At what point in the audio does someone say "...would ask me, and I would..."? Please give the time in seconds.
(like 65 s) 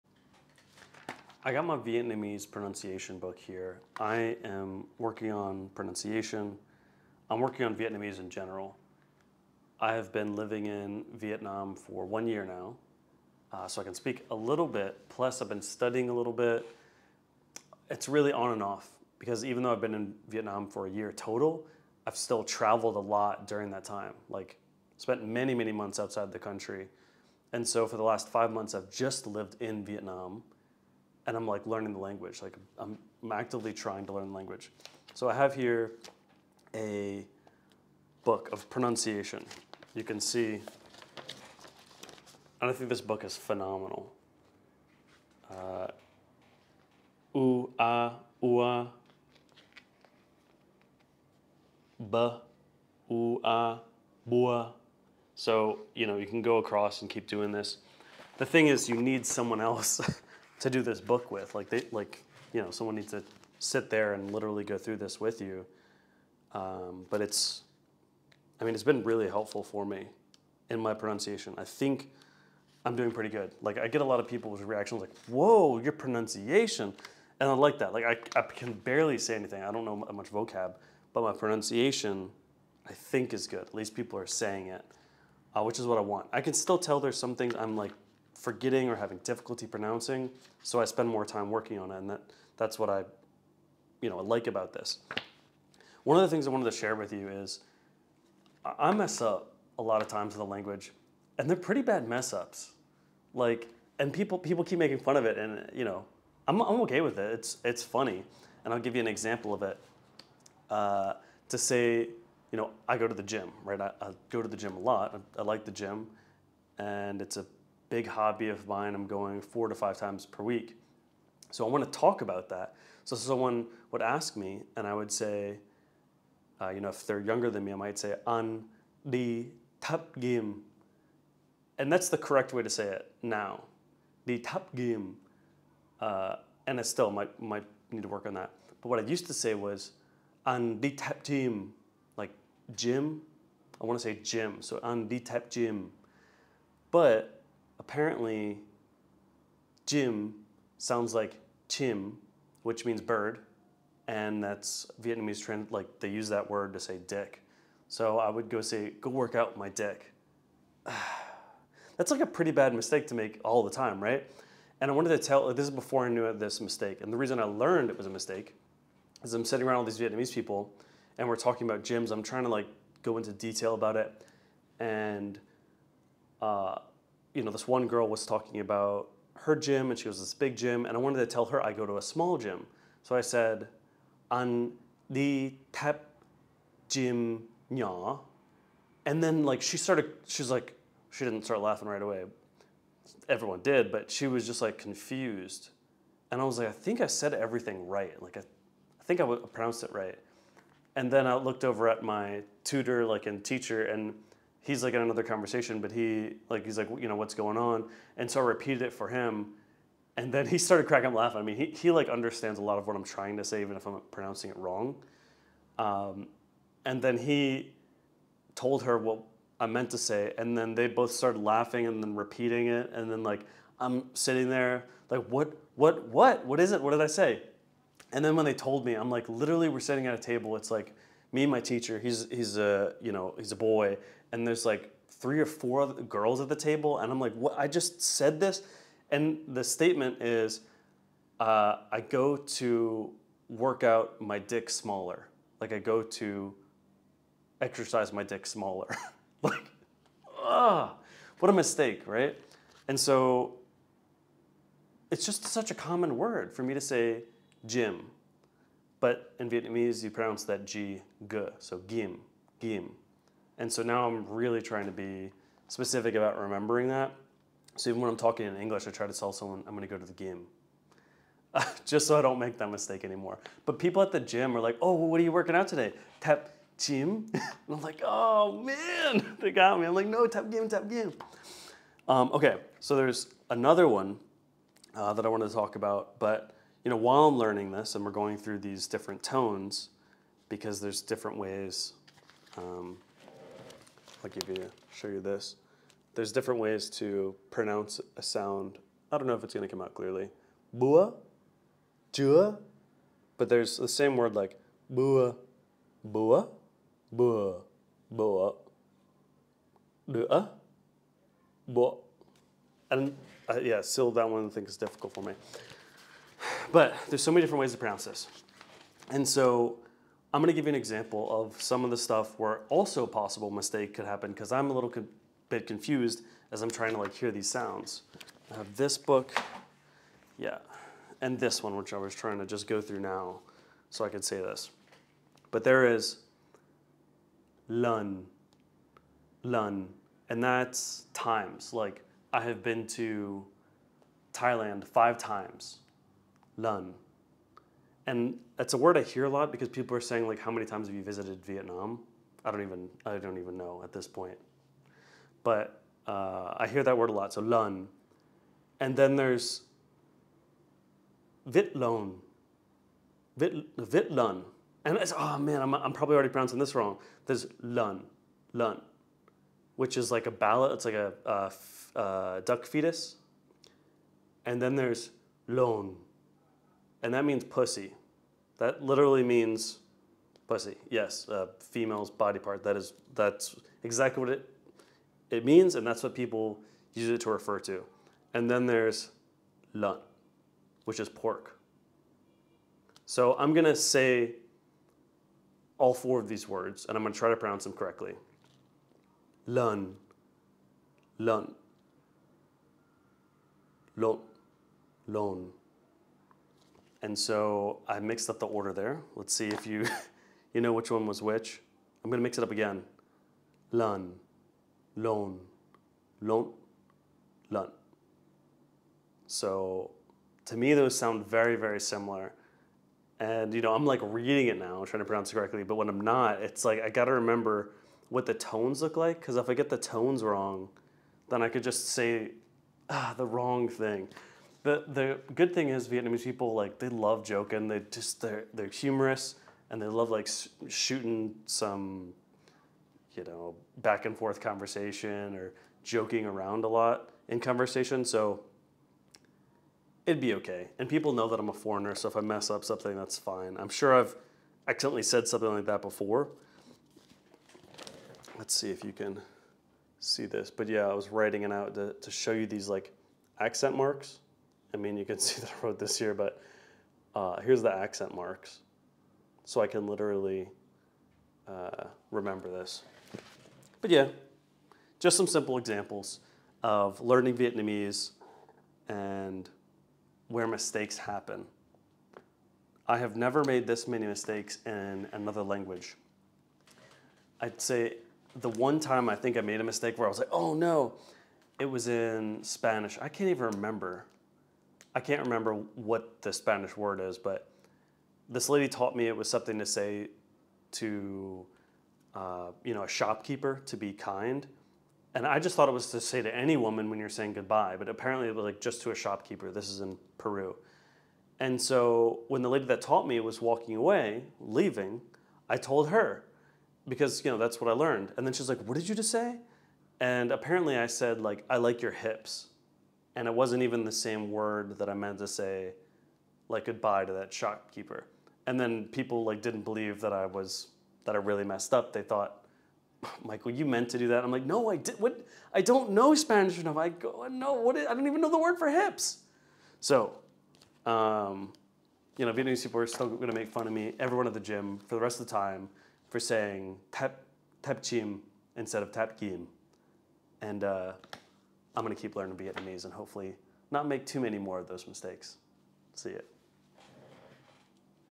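123 s.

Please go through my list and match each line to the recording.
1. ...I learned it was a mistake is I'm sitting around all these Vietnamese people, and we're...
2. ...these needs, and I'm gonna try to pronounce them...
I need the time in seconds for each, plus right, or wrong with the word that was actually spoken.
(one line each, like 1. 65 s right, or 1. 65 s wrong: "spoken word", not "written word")
1. 167 s right
2. 396 s wrong: "words", not "needs".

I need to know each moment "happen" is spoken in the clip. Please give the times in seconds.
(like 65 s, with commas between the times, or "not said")
324 s, 480 s.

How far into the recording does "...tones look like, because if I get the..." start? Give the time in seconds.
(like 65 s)
428 s.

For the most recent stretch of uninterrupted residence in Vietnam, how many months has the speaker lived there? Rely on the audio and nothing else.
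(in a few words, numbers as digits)
five months.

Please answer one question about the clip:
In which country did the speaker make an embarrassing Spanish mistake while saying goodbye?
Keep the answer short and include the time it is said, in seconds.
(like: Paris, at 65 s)
Peru, at 510 s.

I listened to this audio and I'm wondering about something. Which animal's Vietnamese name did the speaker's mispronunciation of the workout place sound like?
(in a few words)
bird.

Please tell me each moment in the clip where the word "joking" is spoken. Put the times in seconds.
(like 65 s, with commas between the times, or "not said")
437 s, 445 s.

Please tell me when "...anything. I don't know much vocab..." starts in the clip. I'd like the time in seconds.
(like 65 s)
79 s.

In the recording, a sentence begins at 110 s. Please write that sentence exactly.
Uh, to say, you know, I go to the gym, right?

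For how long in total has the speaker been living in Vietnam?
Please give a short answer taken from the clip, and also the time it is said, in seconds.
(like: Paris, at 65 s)
one year, at 12 s.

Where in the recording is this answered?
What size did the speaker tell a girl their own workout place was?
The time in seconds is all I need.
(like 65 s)
182 s.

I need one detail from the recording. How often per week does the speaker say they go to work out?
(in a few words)
four to five times.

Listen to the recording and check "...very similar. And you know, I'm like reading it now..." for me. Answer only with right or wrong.
right.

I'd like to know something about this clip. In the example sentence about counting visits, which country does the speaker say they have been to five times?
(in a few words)
Thailand.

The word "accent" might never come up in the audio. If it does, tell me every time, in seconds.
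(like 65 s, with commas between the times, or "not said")
463 s, 467 s.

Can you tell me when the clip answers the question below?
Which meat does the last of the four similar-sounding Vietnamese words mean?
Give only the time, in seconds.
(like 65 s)
391 s.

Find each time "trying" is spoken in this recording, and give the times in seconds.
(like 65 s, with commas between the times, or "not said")
33 s, 172 s, 213 s, 264 s, 326 s, 332 s, 424 s.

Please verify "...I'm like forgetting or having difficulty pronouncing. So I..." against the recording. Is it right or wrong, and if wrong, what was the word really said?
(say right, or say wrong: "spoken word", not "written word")
right.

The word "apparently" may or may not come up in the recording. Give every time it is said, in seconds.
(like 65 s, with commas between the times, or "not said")
147 s, 507 s, 520 s.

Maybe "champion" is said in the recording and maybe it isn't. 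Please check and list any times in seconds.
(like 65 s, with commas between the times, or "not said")
not said.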